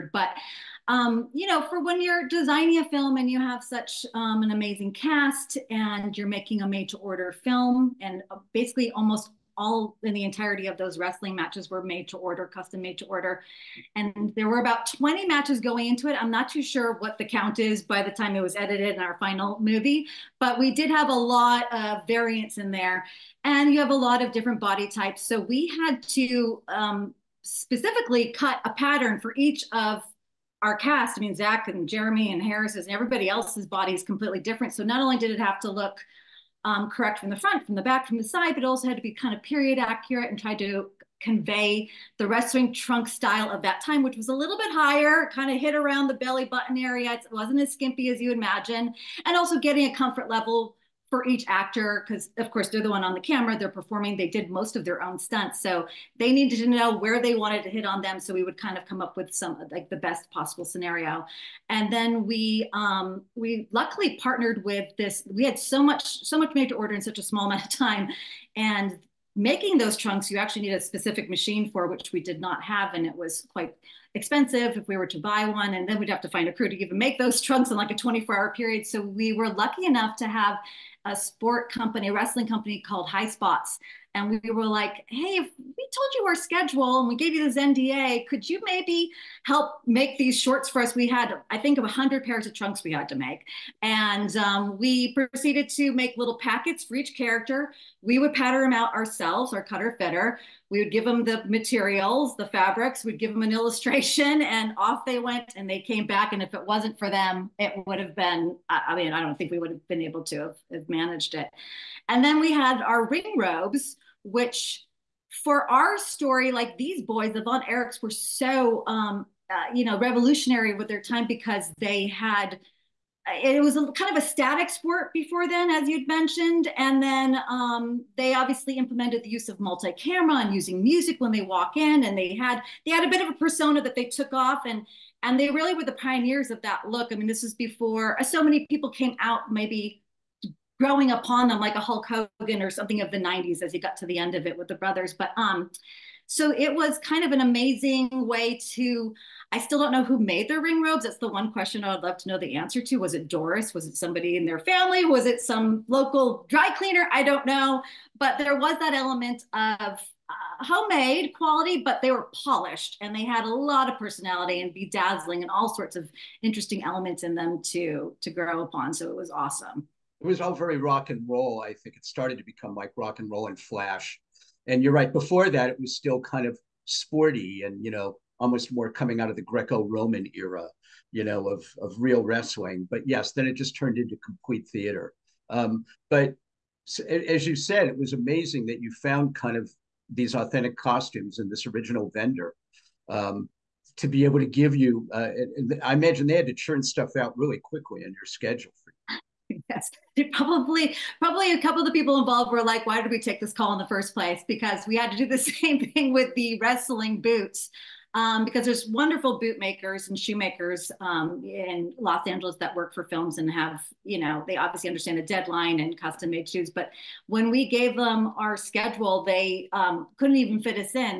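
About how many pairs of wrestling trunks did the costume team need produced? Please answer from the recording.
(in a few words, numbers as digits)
100.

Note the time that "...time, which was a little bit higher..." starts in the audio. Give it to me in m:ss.
0:43.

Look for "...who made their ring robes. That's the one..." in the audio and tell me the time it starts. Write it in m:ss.
2:30.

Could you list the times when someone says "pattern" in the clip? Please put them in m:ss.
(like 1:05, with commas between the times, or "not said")
0:28, 1:38.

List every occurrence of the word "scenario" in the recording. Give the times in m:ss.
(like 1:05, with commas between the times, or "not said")
1:00.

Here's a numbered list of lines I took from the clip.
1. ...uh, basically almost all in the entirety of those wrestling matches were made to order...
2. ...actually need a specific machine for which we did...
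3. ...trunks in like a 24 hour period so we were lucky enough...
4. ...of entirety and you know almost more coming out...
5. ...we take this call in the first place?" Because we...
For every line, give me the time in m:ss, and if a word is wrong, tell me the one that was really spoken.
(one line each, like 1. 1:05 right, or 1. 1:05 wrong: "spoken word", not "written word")
1. 0:08 right
2. 1:10 right
3. 1:17 right
4. 2:56 wrong: "sporty", not "entirety"
5. 3:23 right.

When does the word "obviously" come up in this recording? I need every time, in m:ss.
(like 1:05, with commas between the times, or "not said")
2:08, 3:34.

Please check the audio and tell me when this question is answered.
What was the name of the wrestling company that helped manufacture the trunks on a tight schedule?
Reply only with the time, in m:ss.
1:23.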